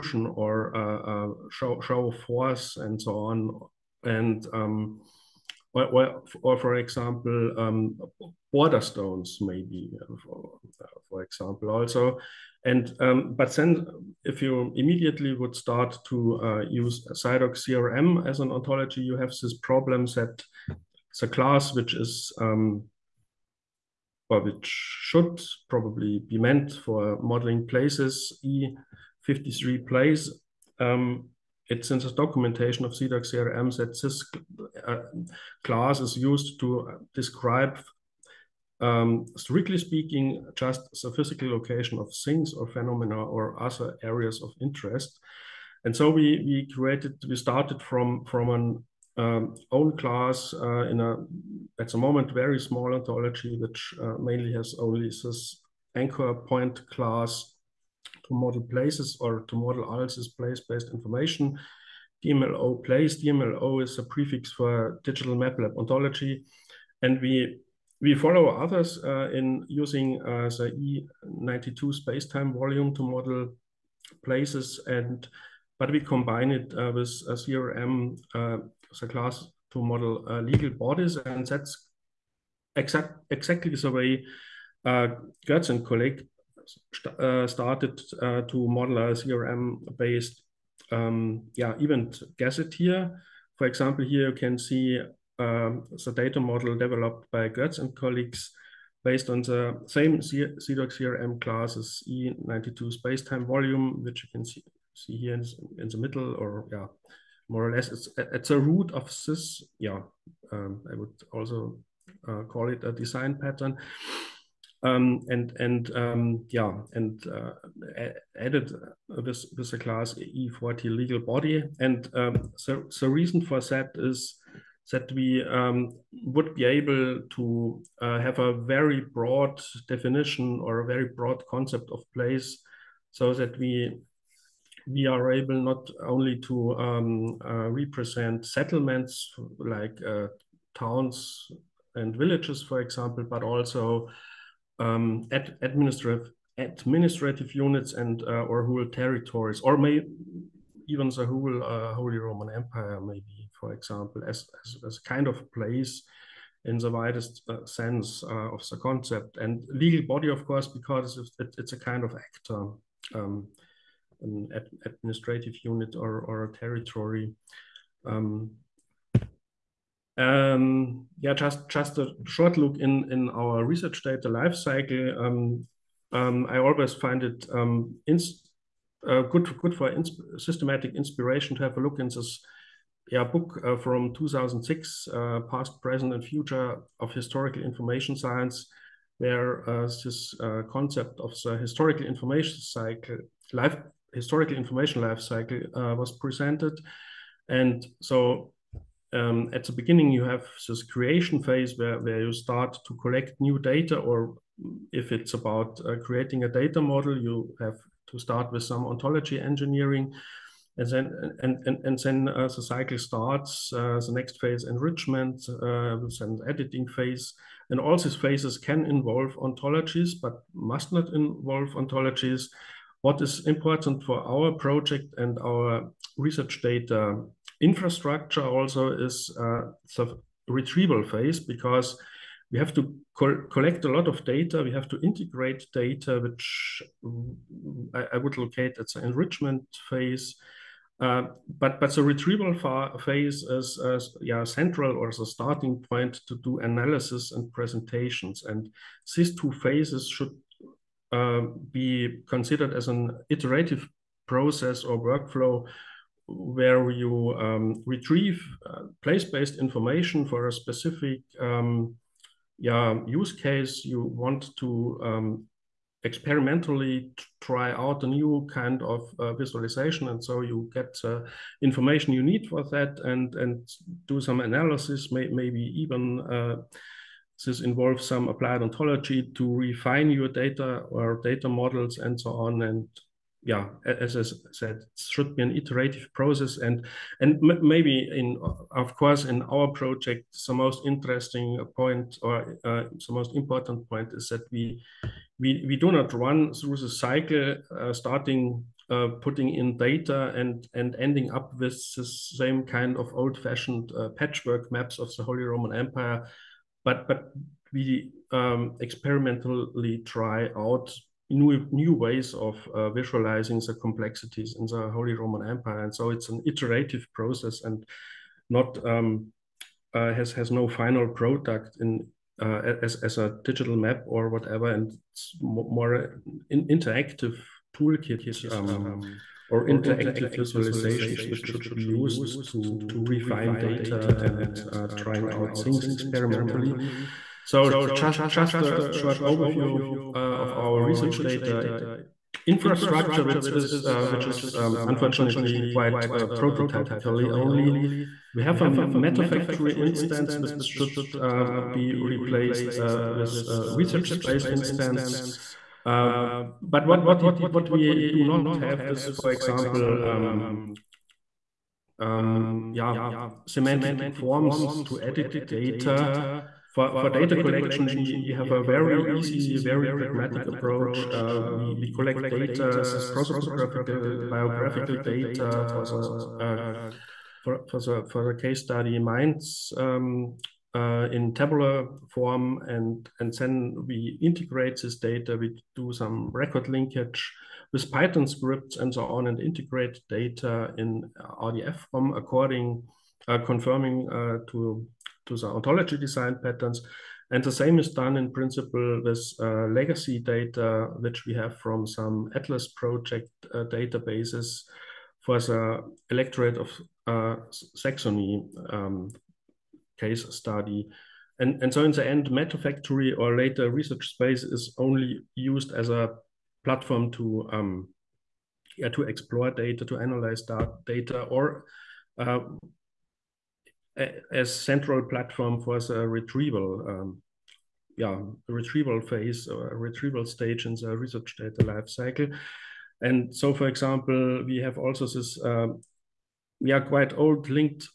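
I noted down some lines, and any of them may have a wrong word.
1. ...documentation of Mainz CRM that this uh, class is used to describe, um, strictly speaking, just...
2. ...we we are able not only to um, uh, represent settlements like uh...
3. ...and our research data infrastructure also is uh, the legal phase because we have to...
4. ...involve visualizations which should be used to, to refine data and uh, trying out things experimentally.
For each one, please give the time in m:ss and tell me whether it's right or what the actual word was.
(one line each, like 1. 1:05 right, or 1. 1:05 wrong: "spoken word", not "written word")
1. 0:32 wrong: "CIDOC", not "Mainz"
2. 2:13 right
3. 3:45 wrong: "retrieval", not "legal"
4. 5:29 wrong: "interactive", not "involve".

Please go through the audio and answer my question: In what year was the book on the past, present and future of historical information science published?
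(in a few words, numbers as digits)
2006.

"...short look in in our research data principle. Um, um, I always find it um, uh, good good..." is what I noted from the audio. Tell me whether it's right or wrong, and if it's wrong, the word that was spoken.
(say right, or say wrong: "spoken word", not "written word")
wrong: "lifecycle", not "principle".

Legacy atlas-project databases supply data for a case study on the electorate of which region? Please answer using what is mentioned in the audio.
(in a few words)
Saxony.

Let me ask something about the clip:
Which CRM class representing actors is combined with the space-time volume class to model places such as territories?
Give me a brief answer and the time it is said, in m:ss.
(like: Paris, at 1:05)
E40 legal body, at 2:00.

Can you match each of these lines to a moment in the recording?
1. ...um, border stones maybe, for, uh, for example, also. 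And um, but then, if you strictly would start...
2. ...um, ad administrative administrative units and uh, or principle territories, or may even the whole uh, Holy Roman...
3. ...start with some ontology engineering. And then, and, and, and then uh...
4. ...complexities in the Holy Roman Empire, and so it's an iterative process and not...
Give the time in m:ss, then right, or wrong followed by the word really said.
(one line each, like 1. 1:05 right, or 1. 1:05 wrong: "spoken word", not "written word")
1. 0:07 wrong: "immediately", not "strictly"
2. 2:24 wrong: "whole", not "principle"
3. 3:28 right
4. 5:13 right.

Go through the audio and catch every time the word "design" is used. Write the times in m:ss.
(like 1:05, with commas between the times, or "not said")
1:52, 6:35.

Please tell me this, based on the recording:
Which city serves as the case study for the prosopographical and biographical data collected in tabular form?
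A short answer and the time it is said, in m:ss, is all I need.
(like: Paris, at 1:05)
Mainz, at 6:18.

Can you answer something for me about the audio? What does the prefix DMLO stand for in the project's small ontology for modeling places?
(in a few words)
digital map lab ontology.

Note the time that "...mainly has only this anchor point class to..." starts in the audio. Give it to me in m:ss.
0:54.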